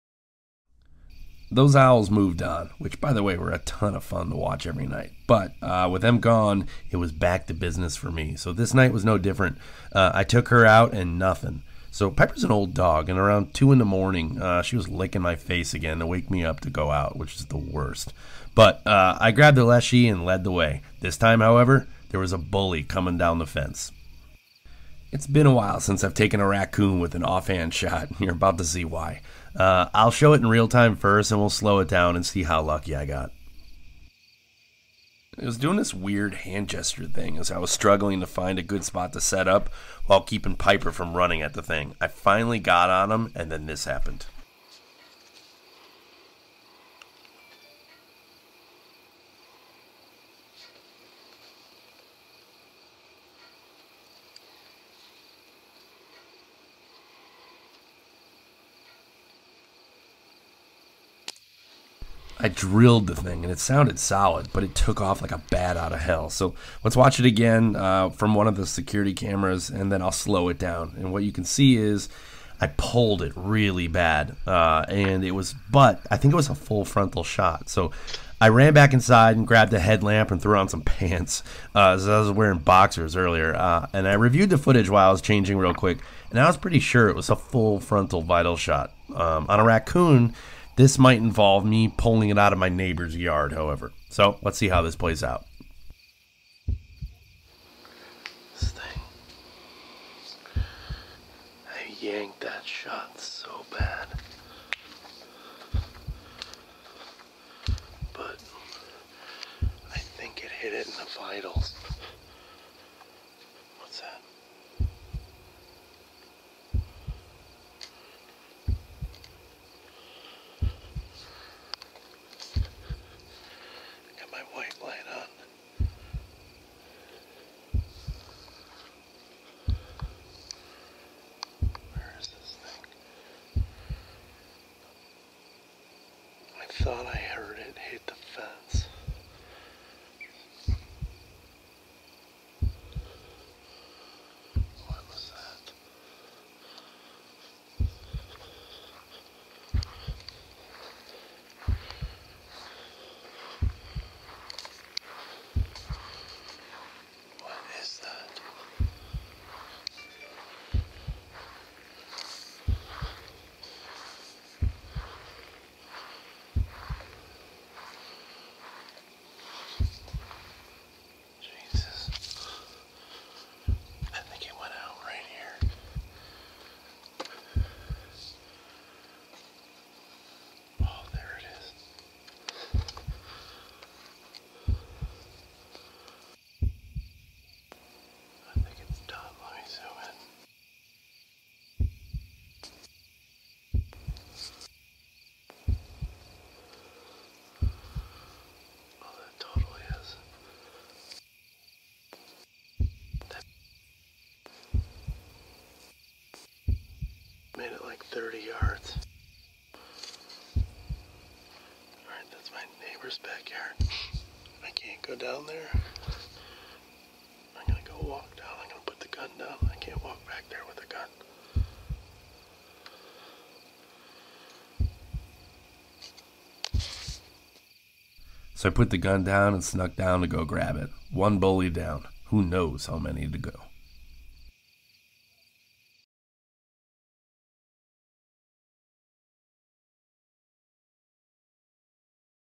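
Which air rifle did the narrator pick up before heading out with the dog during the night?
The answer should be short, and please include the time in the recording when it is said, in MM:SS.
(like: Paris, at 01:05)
Leshiy, at 00:19.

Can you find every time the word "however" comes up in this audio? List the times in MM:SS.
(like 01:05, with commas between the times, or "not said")
00:21, 01:33.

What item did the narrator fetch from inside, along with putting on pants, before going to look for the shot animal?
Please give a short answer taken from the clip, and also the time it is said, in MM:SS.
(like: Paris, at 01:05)
headlamp, at 01:19.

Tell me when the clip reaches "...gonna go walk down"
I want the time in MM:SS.
03:37.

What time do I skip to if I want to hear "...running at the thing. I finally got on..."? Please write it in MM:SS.
00:41.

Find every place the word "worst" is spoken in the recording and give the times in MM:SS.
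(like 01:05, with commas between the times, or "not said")
00:17.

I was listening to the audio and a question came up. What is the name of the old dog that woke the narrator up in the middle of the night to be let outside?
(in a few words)
Pepper.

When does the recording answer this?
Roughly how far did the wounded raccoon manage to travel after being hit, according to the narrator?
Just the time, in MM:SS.
03:28.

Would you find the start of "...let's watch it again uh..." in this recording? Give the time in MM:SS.
01:06.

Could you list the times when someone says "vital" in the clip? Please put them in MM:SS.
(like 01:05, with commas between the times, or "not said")
01:28, 01:51.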